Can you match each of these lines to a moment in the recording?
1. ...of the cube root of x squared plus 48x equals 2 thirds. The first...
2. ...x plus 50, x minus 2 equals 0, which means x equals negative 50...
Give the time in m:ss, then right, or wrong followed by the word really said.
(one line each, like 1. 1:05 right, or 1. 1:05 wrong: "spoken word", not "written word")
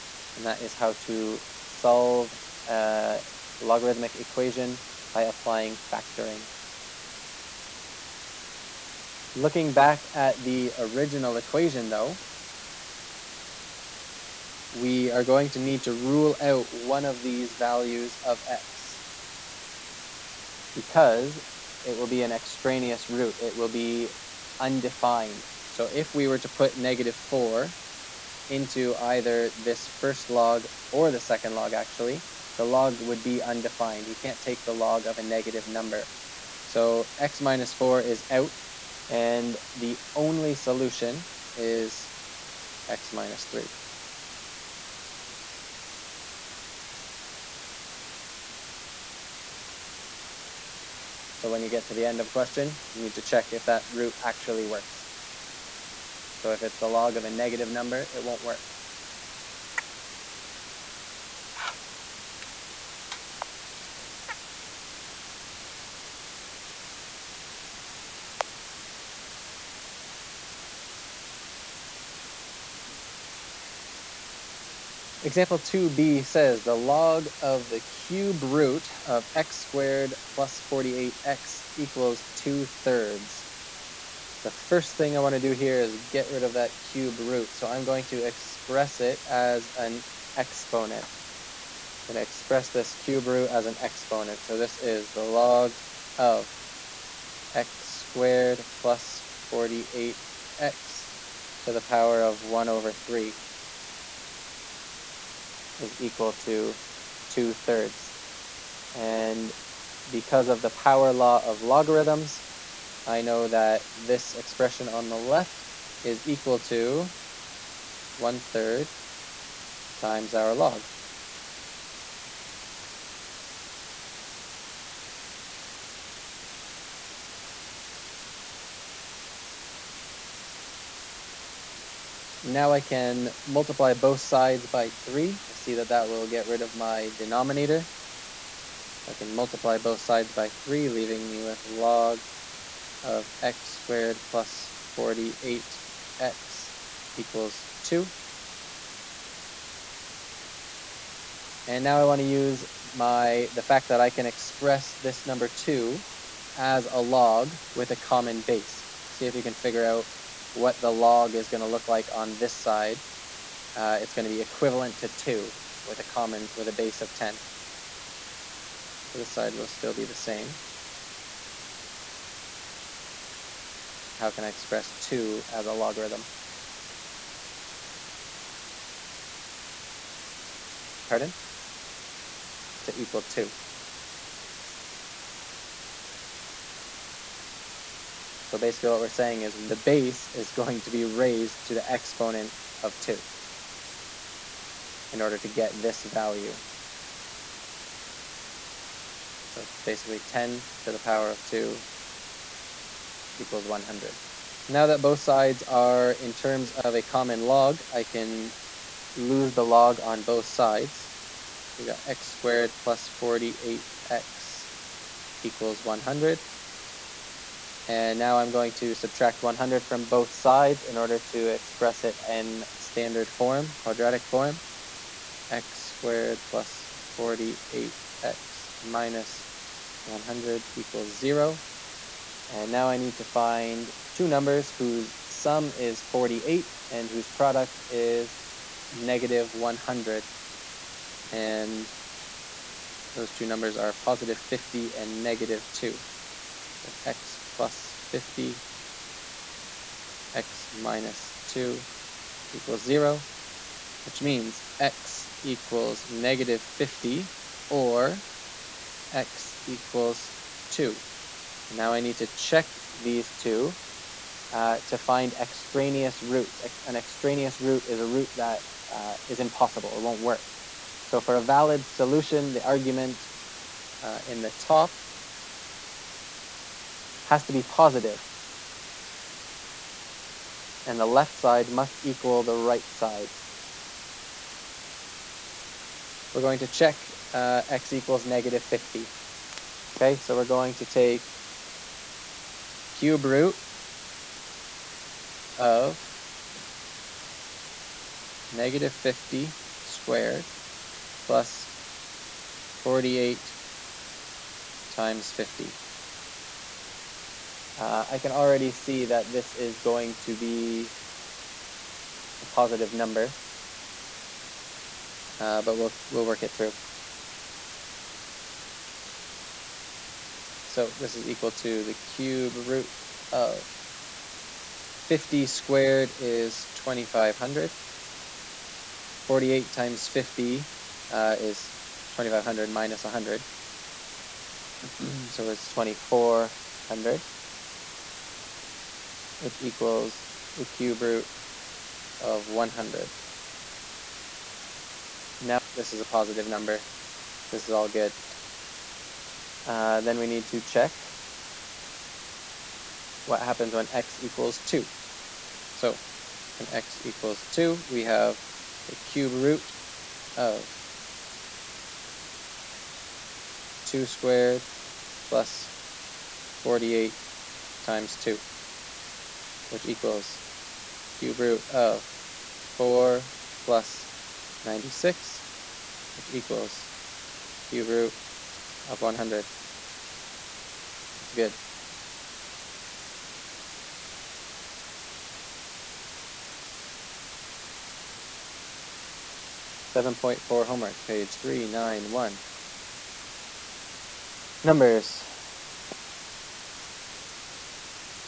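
1. 1:17 right
2. 4:07 right.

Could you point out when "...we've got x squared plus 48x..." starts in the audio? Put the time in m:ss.
3:31.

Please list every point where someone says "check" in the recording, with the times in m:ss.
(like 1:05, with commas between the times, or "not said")
0:53, 4:22, 4:46, 5:50.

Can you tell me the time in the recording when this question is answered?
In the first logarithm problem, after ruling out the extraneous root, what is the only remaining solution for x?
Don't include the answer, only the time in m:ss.
0:42.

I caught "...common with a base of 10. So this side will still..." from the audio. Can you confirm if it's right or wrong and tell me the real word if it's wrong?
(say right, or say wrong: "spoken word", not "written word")
right.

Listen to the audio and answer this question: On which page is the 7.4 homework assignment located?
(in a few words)
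391.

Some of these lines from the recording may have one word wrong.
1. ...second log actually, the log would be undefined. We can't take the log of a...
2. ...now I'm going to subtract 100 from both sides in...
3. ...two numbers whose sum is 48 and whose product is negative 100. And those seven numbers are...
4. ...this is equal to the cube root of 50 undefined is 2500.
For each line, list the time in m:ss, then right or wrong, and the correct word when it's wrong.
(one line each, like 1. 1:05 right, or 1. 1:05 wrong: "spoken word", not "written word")
1. 0:31 right
2. 3:38 right
3. 3:54 wrong: "two", not "seven"
4. 5:20 wrong: "squared", not "undefined".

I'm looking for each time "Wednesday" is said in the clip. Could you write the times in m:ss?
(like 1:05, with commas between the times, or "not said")
not said.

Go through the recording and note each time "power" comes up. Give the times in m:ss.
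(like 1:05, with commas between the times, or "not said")
1:41, 1:50, 3:20.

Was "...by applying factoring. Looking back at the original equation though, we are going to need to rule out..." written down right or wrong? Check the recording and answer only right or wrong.
right.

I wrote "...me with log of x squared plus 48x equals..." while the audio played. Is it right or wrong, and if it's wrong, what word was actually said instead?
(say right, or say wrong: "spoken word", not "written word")
right.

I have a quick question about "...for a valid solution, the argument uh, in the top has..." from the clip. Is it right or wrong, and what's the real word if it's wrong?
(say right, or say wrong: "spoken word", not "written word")
right.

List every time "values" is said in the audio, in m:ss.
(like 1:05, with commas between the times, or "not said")
0:17, 3:16.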